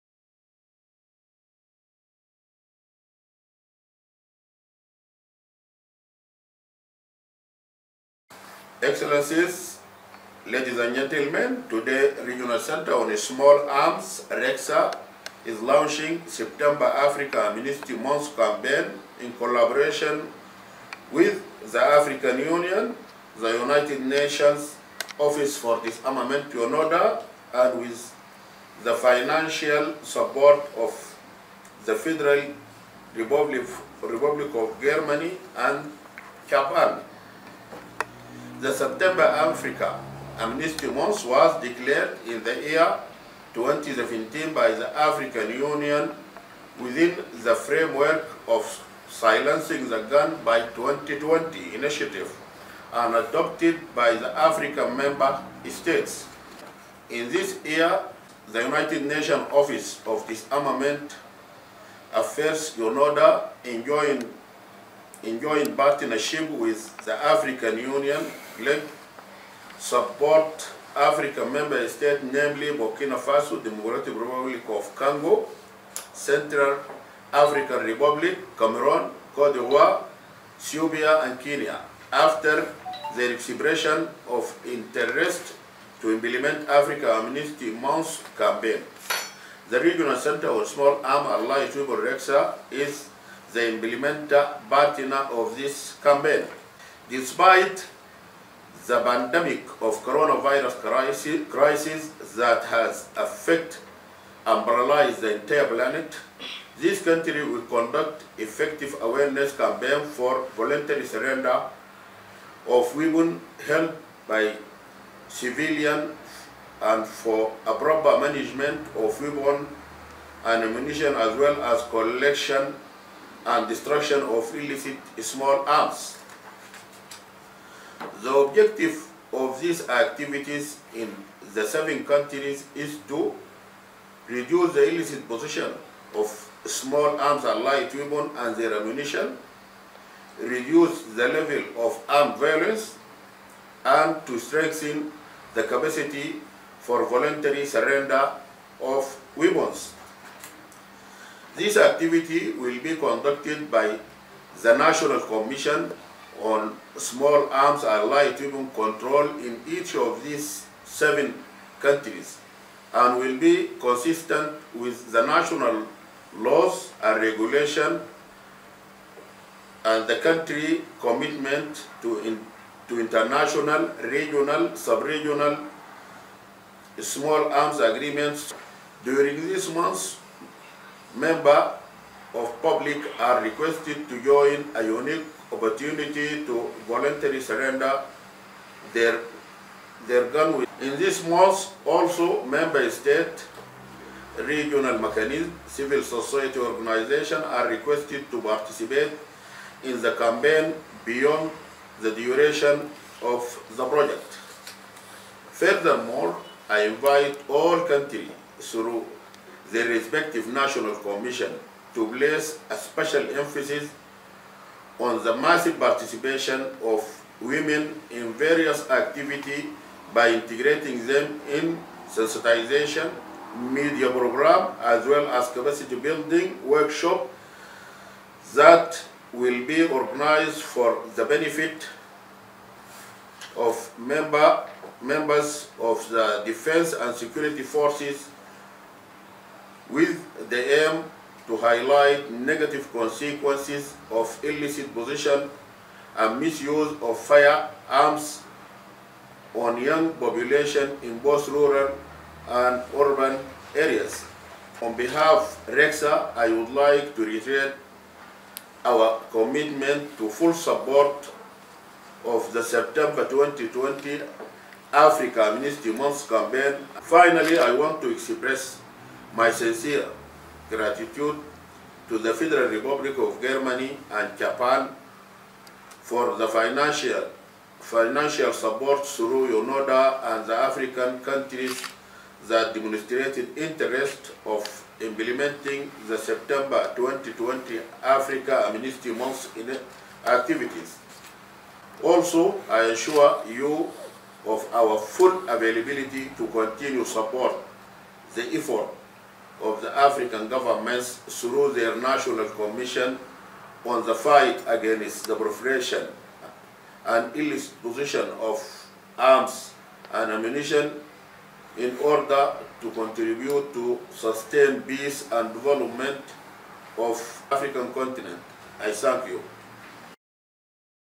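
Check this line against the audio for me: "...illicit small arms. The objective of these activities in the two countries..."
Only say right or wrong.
wrong.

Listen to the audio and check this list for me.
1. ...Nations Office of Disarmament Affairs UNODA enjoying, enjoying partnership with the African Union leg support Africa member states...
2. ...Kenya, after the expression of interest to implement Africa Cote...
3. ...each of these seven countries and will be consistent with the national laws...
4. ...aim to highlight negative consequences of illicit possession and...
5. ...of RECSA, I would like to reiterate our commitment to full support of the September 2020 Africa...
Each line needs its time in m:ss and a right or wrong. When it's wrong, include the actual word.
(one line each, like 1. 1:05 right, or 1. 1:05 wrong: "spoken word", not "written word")
1. 0:59 right
2. 1:21 wrong: "Amnesty", not "Cote"
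3. 2:39 right
4. 4:00 right
5. 4:15 right.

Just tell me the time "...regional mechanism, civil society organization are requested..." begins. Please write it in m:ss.
3:14.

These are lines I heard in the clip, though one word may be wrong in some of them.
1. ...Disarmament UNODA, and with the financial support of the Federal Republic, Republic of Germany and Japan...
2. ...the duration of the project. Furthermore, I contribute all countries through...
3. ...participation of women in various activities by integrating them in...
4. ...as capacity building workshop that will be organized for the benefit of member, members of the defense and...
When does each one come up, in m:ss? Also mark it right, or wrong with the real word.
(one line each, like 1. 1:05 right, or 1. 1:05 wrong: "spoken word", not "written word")
1. 0:25 right
2. 3:22 wrong: "invite", not "contribute"
3. 3:35 right
4. 3:45 right.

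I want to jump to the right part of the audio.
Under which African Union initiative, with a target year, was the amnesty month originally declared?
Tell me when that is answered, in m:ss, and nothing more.
0:49.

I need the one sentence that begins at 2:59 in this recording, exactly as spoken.
During this month, members of public are requested to join a unique opportunity to voluntarily surrender their, their gun.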